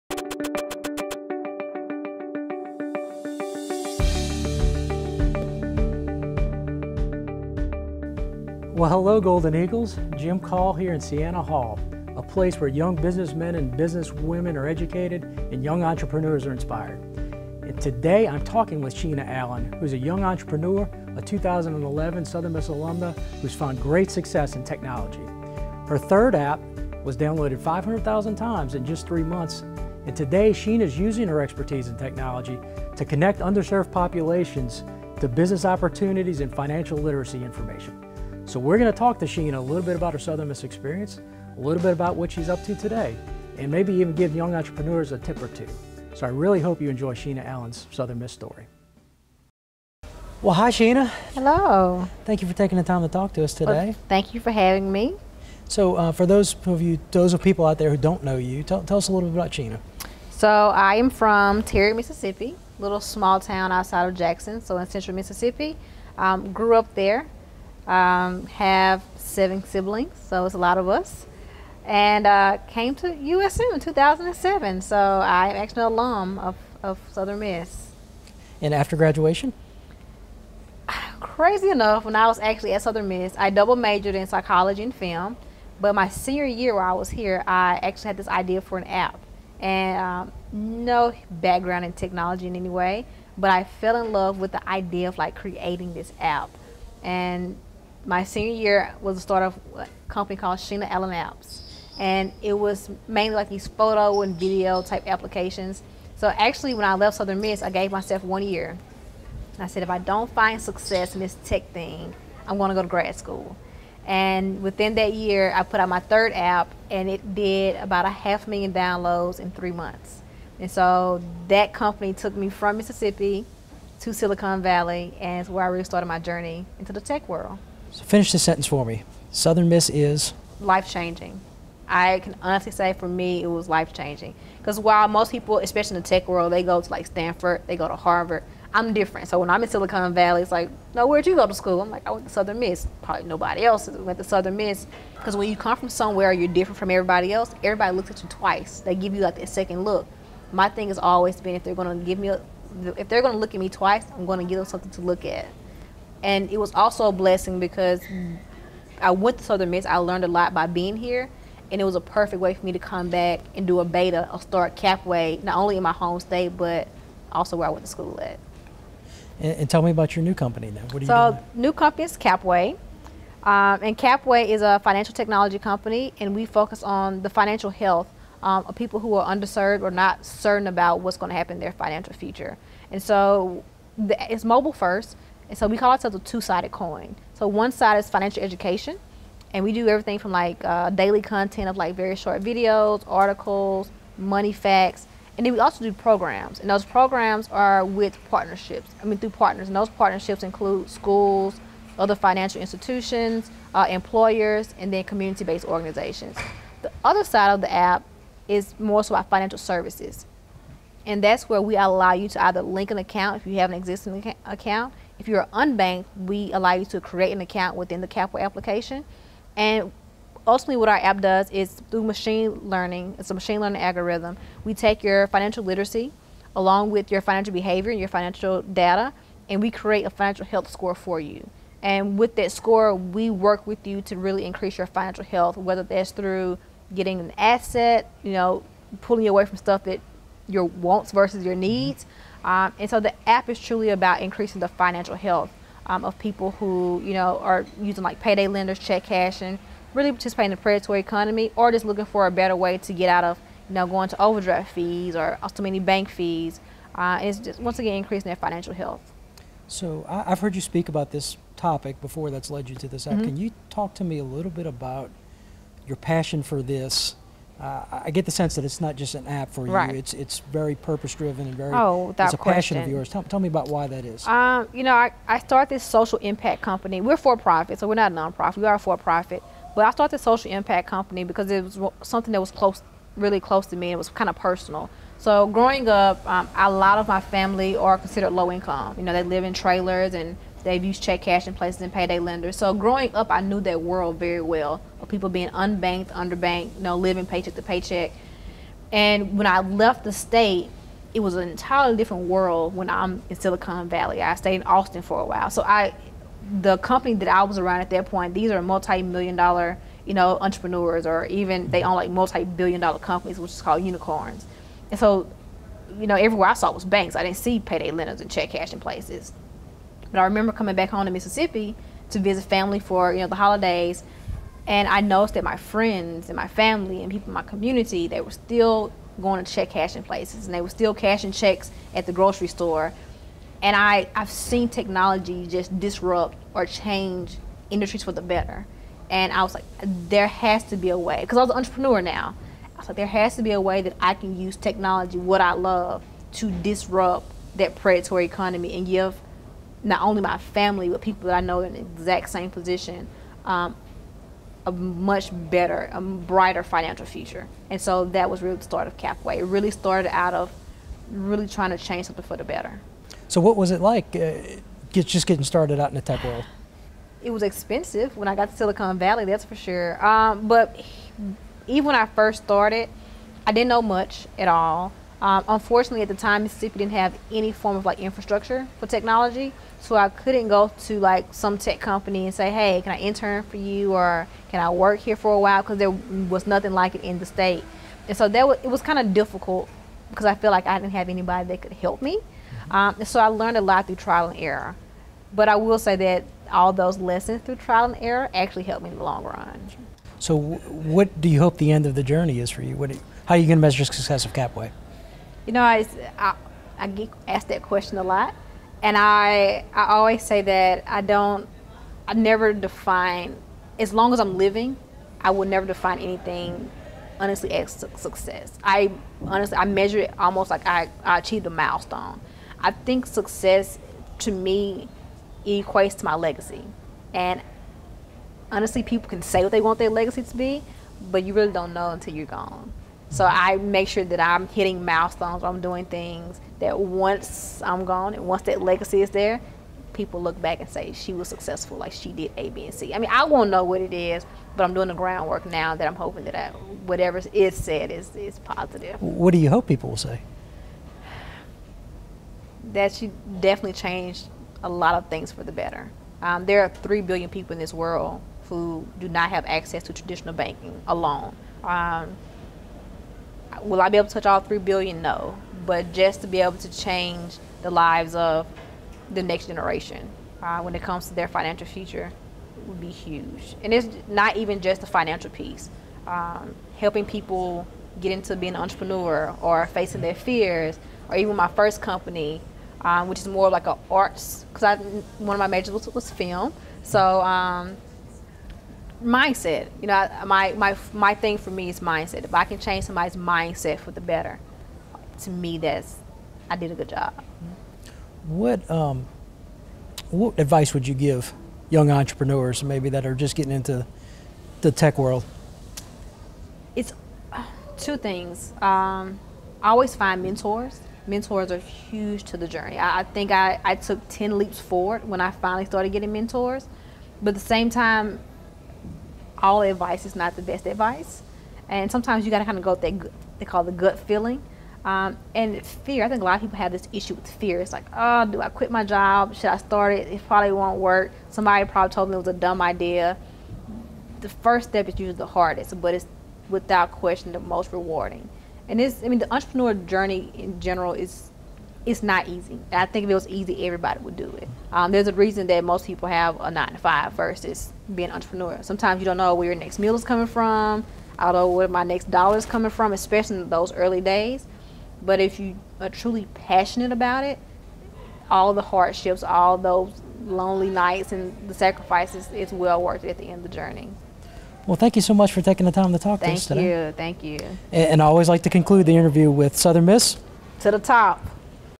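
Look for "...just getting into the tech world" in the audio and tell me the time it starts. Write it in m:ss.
8:23.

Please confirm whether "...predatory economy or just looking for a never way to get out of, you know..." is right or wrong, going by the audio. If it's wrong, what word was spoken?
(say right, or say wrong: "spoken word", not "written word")
wrong: "better", not "never".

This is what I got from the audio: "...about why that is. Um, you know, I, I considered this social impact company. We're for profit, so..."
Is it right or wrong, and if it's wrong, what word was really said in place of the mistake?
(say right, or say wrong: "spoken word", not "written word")
wrong: "started", not "considered".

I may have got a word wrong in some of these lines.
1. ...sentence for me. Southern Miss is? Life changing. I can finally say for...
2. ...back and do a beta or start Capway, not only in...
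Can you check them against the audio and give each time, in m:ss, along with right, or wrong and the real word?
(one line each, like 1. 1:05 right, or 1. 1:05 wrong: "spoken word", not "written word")
1. 2:08 wrong: "honestly", not "finally"
2. 2:43 right.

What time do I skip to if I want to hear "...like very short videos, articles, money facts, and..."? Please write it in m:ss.
3:11.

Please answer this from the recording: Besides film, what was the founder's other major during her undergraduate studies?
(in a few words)
Psychology.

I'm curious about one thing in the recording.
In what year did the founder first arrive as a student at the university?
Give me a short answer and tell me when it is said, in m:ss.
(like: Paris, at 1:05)
2007, at 1:13.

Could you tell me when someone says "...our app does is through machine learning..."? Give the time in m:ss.
3:40.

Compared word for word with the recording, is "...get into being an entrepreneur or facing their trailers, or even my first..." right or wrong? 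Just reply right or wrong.
wrong.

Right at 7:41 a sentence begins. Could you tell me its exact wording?
Um, will I be able to touch all three billion?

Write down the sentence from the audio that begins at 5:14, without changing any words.
And so, you know, everywhere I saw was banks.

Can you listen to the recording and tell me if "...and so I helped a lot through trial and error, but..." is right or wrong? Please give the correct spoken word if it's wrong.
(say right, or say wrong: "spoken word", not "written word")
wrong: "learned", not "helped".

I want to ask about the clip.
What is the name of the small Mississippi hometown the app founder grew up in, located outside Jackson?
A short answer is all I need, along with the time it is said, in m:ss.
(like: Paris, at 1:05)
Terry, at 1:01.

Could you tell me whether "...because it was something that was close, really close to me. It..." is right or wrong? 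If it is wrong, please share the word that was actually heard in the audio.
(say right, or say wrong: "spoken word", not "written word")
right.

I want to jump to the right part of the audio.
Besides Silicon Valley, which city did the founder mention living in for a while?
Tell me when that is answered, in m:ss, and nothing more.
5:04.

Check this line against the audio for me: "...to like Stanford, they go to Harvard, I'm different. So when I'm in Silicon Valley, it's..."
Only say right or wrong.
right.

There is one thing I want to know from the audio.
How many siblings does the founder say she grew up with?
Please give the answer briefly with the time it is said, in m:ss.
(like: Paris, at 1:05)
7, at 1:09.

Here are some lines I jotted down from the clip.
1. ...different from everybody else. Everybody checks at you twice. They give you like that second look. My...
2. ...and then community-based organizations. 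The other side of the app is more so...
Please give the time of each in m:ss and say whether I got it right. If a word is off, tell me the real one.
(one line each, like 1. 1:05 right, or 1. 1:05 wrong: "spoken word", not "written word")
1. 2:26 wrong: "looks", not "checks"
2. 3:24 right.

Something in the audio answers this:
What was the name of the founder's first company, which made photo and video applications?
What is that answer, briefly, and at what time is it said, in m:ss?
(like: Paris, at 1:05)
Sheena Allen Apps, at 1:40.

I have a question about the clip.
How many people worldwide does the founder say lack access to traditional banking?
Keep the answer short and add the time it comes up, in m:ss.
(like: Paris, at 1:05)
3 billion, at 7:36.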